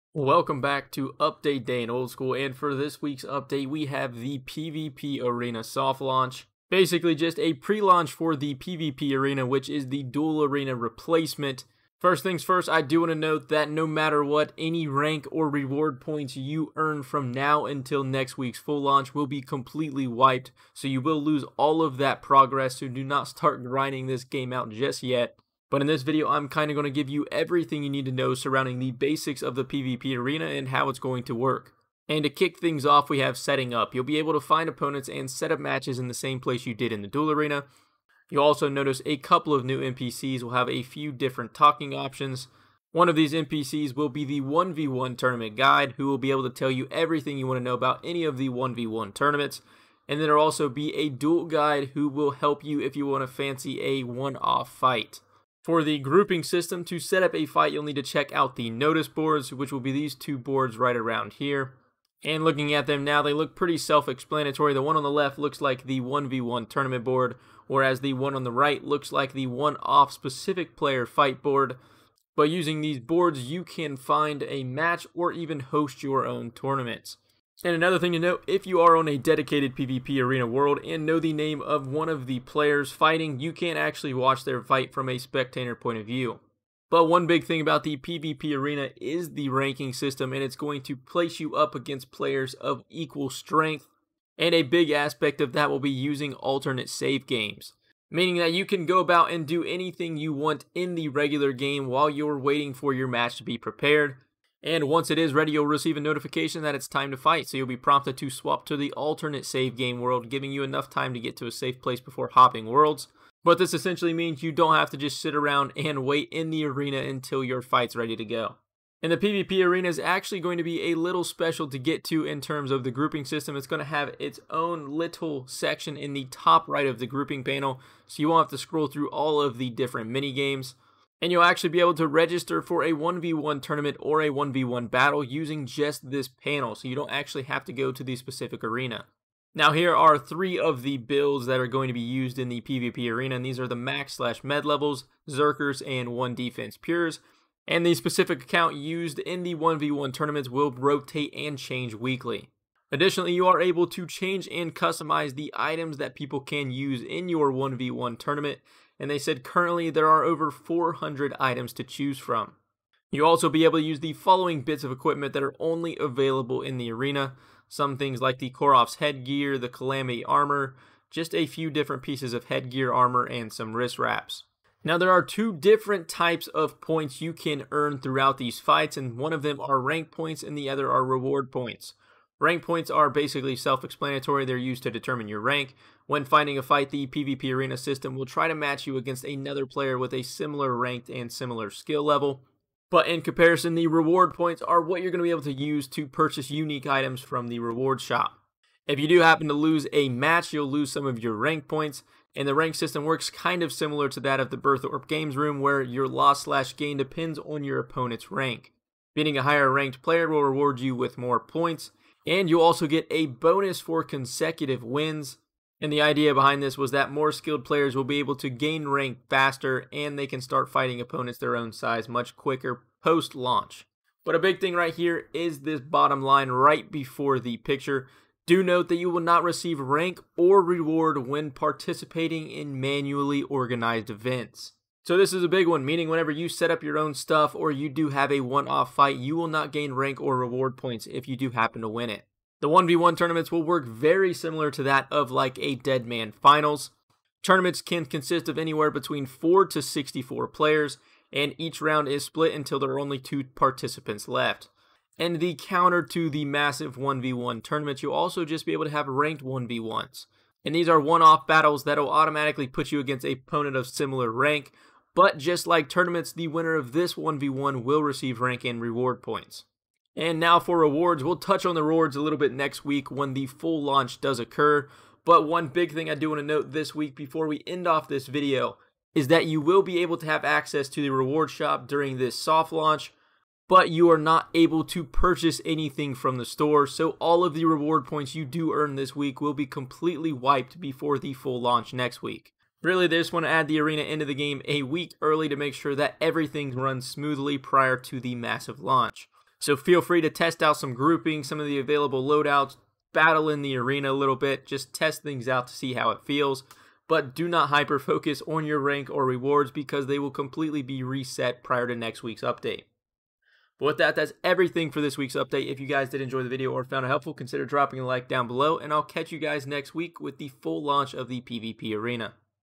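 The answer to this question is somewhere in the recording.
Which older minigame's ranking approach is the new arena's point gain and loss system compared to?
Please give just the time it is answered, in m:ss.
3:24.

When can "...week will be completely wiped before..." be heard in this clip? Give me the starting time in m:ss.
4:49.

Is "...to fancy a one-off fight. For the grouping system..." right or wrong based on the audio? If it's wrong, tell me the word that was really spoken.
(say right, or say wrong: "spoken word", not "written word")
right.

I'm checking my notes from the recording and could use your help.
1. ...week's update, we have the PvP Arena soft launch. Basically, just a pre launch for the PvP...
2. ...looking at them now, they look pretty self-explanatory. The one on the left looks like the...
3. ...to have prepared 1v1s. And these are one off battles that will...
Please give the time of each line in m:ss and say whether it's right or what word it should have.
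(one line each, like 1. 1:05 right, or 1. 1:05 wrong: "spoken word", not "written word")
1. 0:03 right
2. 1:02 right
3. 4:18 wrong: "ranked", not "prepared".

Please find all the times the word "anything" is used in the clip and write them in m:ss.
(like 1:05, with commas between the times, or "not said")
1:39, 4:45.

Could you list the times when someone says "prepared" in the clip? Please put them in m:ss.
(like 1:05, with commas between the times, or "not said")
1:43.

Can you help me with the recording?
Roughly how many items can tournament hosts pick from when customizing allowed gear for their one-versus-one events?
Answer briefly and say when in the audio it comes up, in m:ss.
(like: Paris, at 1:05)
400, at 2:40.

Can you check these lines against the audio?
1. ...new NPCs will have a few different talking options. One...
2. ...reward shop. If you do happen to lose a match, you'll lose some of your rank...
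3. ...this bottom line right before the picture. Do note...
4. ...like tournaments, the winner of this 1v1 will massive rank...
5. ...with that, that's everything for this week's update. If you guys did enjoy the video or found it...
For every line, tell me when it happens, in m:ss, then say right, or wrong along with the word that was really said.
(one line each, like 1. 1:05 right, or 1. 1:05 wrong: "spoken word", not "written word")
1. 0:39 right
2. 3:17 right
3. 3:45 right
4. 4:25 wrong: "receive", not "massive"
5. 5:13 right.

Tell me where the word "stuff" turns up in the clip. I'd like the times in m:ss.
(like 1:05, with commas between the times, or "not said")
3:57.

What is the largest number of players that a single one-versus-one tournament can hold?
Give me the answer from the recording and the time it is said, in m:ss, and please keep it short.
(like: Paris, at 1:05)
64, at 4:09.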